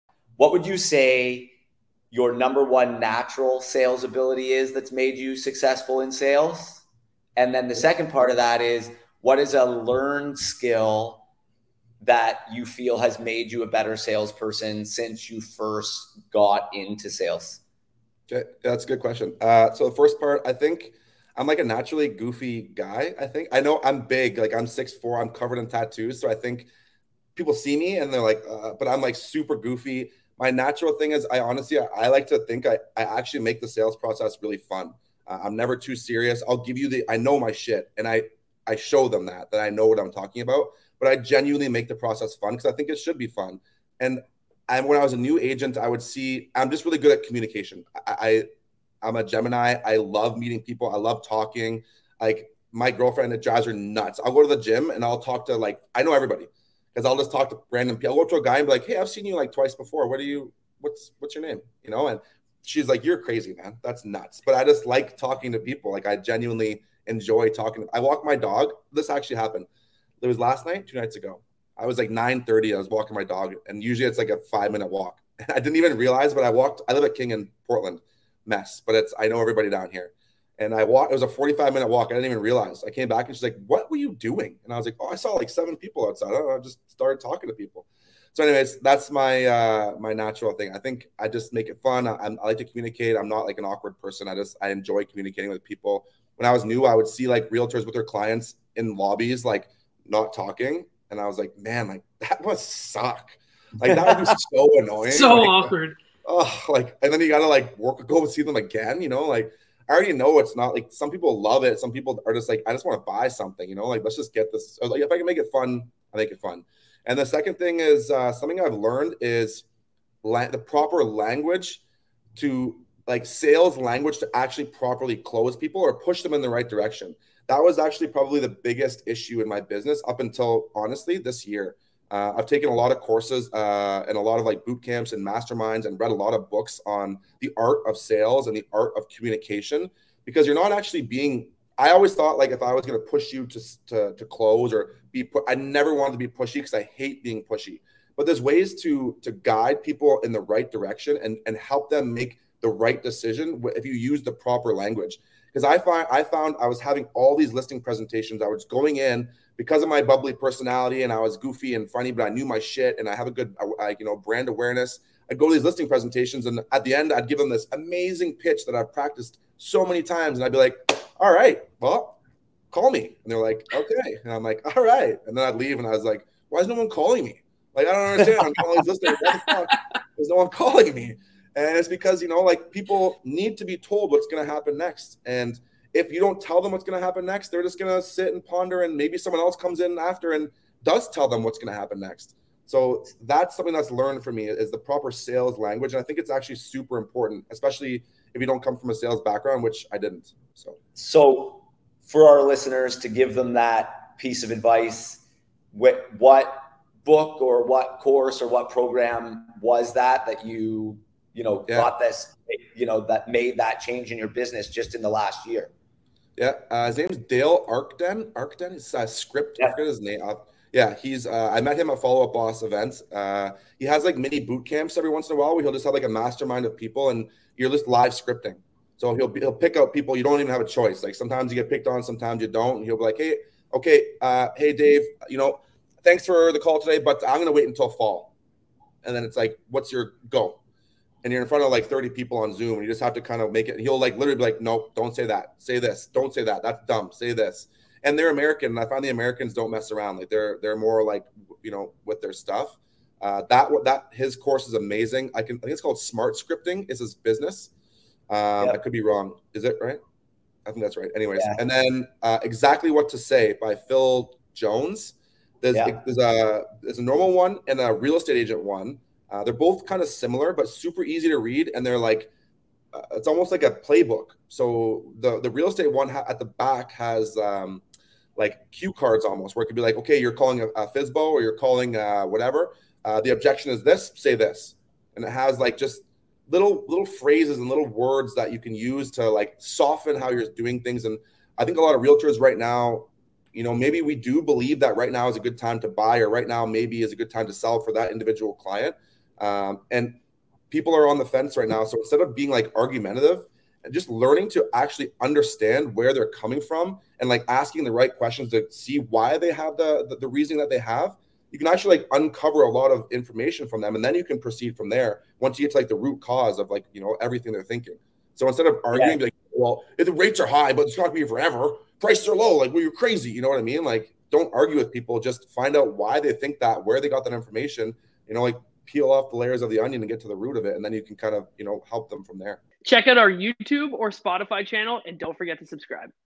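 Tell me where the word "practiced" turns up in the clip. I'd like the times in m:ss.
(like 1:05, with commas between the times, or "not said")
2:48.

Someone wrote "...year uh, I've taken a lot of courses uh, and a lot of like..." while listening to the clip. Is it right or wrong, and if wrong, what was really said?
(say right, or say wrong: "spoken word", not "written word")
right.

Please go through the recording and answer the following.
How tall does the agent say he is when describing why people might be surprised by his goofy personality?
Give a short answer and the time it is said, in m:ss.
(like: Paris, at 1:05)
6'4", at 0:24.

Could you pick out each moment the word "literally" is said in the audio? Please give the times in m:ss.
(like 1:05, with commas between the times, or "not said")
4:04.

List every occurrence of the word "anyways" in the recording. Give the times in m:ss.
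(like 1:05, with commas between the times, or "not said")
1:28, 4:21.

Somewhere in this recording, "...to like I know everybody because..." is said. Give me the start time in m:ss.
0:55.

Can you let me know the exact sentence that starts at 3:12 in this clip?
So that's something that's learned for me is the proper sales language.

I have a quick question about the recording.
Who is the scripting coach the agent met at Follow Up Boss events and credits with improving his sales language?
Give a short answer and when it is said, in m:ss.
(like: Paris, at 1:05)
Dale Archdekin, at 3:37.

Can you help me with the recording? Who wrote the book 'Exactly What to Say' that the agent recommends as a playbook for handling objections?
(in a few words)
Phil Jones.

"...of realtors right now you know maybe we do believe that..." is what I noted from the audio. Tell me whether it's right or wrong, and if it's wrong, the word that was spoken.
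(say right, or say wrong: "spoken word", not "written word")
right.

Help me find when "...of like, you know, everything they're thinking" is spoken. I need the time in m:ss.
5:16.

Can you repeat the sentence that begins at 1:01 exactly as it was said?
You know?" And she's like, "You're crazy, man.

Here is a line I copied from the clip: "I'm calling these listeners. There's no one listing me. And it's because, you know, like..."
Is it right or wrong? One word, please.
wrong.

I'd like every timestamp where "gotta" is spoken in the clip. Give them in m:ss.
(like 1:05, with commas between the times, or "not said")
1:47.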